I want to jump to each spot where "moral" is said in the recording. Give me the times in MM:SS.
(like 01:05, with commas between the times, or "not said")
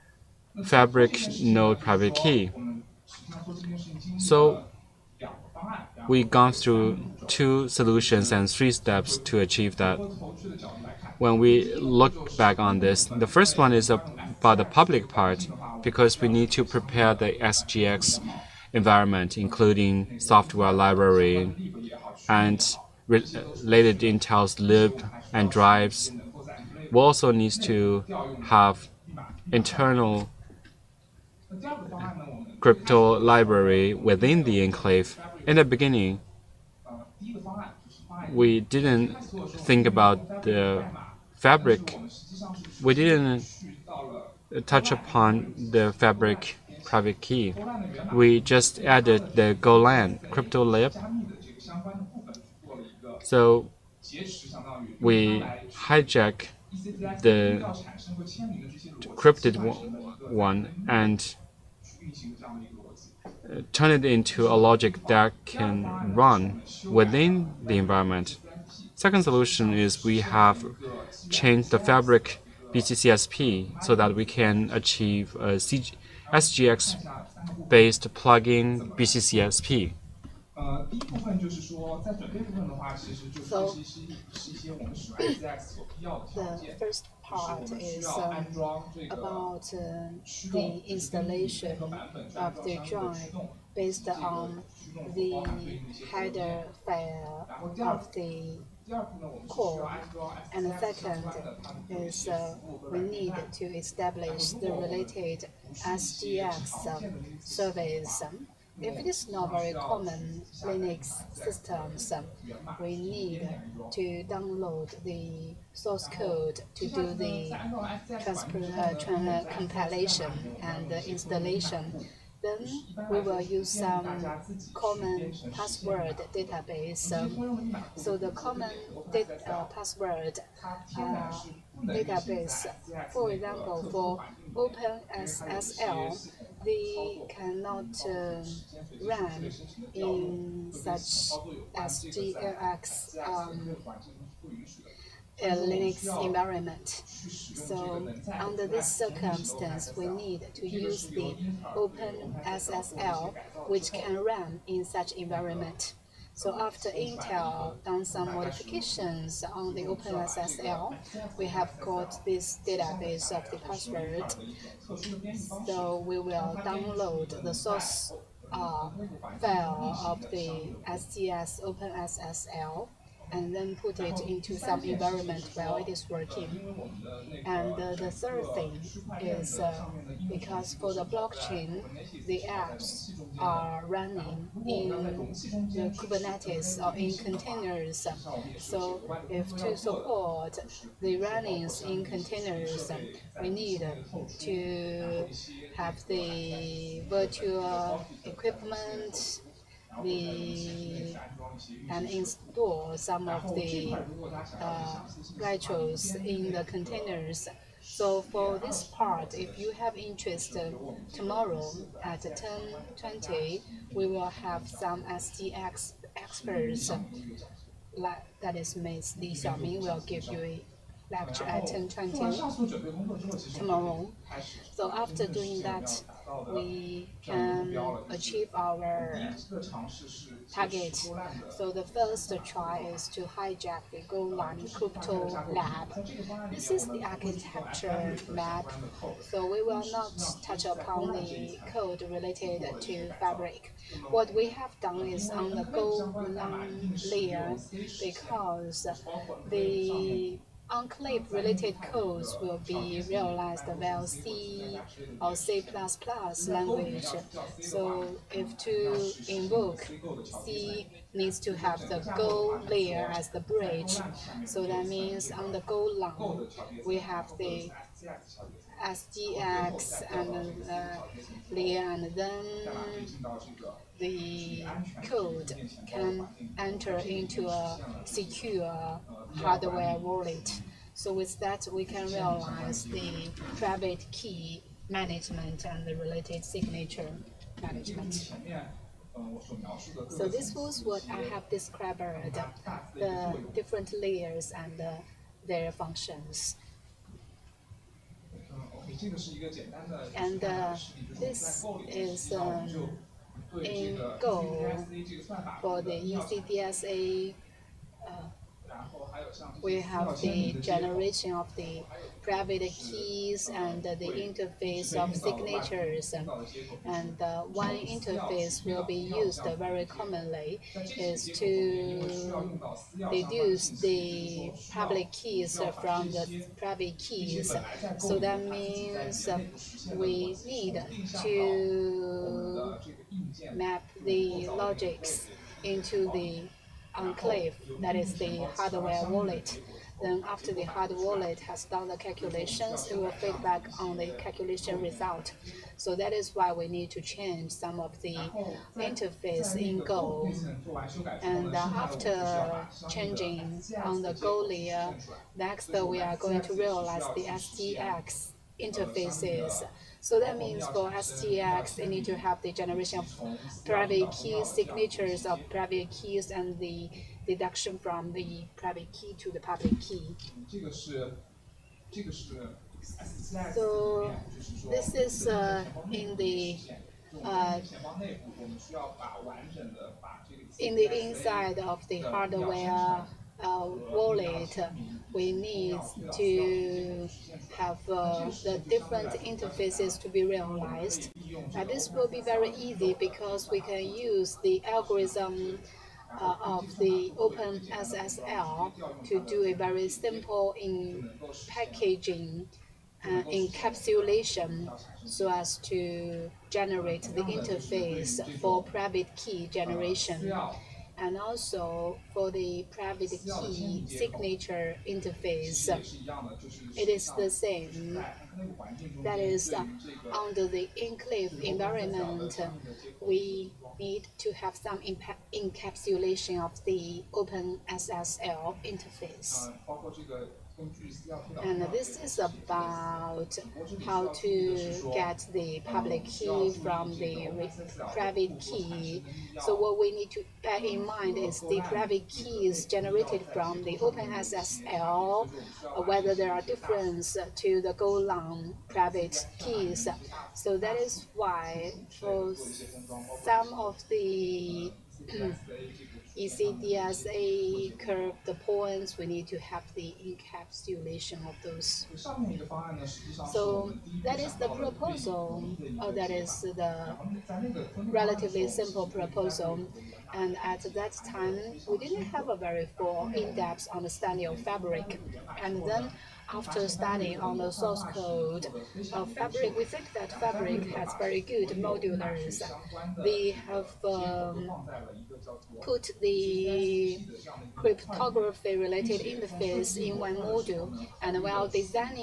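not said.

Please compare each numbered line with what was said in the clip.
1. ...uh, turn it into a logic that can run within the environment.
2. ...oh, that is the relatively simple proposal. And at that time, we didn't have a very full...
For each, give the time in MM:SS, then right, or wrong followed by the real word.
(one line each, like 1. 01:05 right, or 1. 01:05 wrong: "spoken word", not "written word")
1. 01:03 right
2. 07:45 right.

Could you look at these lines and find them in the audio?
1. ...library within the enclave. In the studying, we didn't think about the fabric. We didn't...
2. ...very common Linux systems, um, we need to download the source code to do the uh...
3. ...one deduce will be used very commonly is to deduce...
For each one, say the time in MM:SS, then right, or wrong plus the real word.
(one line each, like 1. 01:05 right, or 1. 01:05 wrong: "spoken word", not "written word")
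1. 00:33 wrong: "beginning", not "studying"
2. 01:49 right
3. 05:17 wrong: "interface", not "deduce".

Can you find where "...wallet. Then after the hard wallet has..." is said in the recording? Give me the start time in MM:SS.
05:39.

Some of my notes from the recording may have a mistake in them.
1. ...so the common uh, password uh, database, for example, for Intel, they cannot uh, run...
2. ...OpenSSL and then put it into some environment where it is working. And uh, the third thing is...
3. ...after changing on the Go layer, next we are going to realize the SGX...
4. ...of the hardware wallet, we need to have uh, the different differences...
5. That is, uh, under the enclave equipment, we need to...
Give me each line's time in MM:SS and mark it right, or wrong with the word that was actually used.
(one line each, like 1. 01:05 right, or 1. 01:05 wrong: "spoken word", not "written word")
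1. 02:07 wrong: "OpenSSL", not "Intel"
2. 02:51 right
3. 05:51 right
4. 06:21 wrong: "interfaces", not "differences"
5. 06:59 wrong: "environment", not "equipment".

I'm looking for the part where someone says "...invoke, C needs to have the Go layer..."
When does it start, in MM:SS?
04:19.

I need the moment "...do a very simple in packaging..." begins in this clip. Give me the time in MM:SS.
06:39.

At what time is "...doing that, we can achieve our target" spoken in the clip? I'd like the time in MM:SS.
03:45.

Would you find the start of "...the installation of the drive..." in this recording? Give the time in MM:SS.
01:30.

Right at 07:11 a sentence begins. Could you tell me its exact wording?
And this is about how to get the public key from the private key.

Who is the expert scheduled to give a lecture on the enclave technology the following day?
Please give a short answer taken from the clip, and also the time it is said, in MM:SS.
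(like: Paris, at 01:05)
Li Xiaoming, at 03:39.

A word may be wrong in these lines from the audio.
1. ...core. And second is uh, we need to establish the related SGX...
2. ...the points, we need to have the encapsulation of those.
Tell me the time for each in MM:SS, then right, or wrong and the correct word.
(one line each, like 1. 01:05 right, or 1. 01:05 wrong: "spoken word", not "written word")
1. 01:39 right
2. 07:38 right.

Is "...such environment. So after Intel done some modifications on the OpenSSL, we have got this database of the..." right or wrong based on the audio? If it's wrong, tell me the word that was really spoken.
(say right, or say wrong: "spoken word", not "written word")
right.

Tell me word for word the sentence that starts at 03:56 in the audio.
This is the architecture map, so we will not touch upon the code related to Fabric.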